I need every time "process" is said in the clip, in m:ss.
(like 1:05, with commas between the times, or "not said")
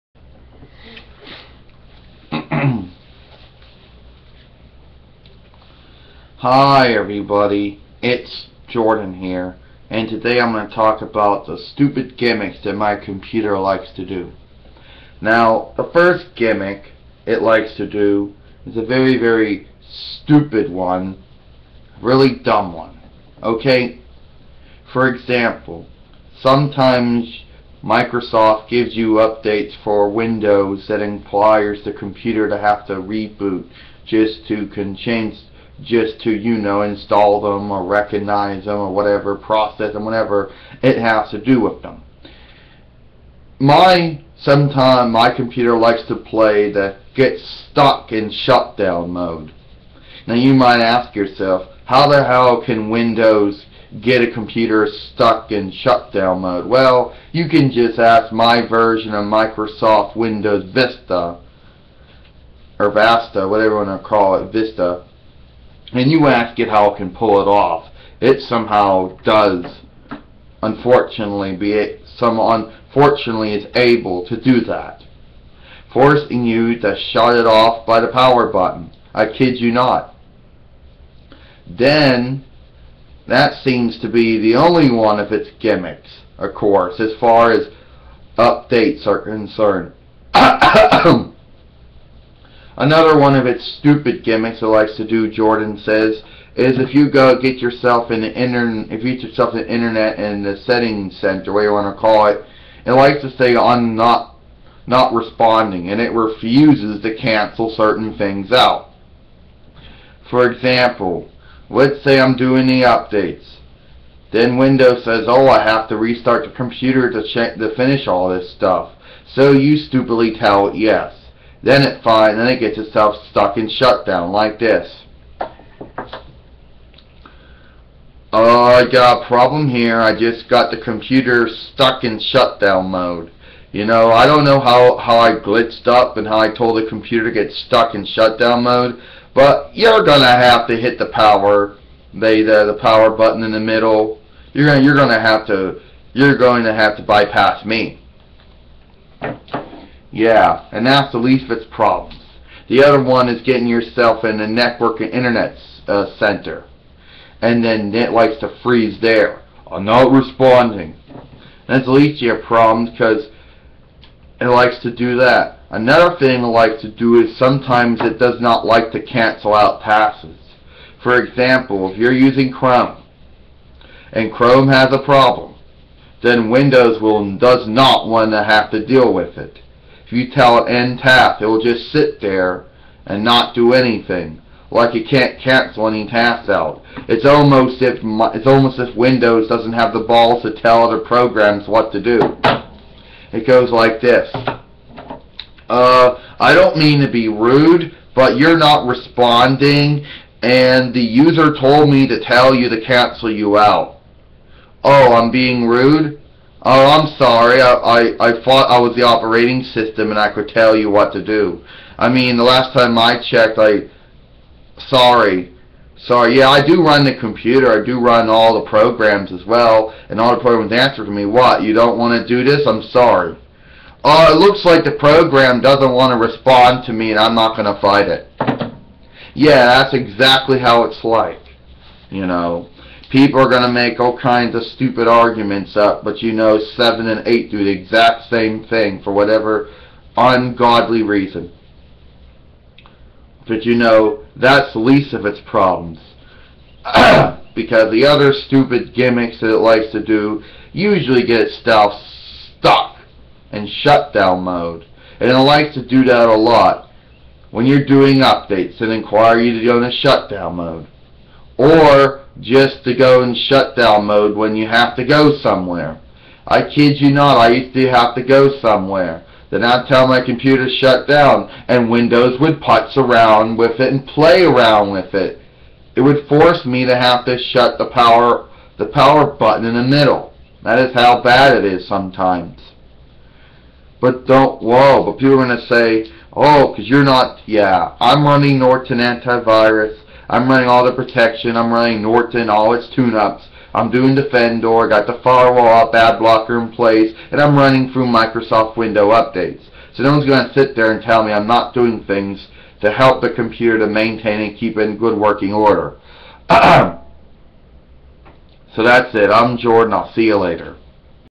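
0:39.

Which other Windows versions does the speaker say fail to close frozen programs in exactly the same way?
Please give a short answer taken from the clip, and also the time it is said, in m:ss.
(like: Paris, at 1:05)
7 and 8, at 3:56.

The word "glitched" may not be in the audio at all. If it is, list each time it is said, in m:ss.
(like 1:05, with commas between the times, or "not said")
2:15.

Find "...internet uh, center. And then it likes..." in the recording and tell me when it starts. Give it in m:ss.
2:35.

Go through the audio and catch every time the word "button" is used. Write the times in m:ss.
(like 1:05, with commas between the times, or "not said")
1:18, 2:23, 4:39.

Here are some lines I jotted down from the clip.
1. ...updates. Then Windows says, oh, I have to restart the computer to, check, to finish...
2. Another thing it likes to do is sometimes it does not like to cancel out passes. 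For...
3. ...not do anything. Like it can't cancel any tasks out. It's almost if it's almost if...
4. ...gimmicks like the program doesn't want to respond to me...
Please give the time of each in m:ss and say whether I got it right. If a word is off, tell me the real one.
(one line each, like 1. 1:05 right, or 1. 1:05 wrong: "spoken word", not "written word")
1. 1:52 right
2. 2:45 right
3. 3:03 right
4. 3:44 wrong: "looks", not "gimmicks".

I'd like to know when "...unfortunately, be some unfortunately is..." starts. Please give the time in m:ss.
1:10.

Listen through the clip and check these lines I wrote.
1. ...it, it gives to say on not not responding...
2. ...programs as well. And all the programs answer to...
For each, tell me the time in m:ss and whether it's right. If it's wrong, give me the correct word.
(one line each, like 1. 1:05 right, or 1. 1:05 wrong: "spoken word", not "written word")
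1. 1:42 wrong: "likes", not "gives"
2. 3:38 right.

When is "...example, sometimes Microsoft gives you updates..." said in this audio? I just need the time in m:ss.
0:25.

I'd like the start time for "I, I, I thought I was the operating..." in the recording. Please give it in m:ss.
3:27.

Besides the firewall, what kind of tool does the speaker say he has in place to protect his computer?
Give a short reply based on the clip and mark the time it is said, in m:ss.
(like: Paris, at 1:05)
Ad blocker, at 4:55.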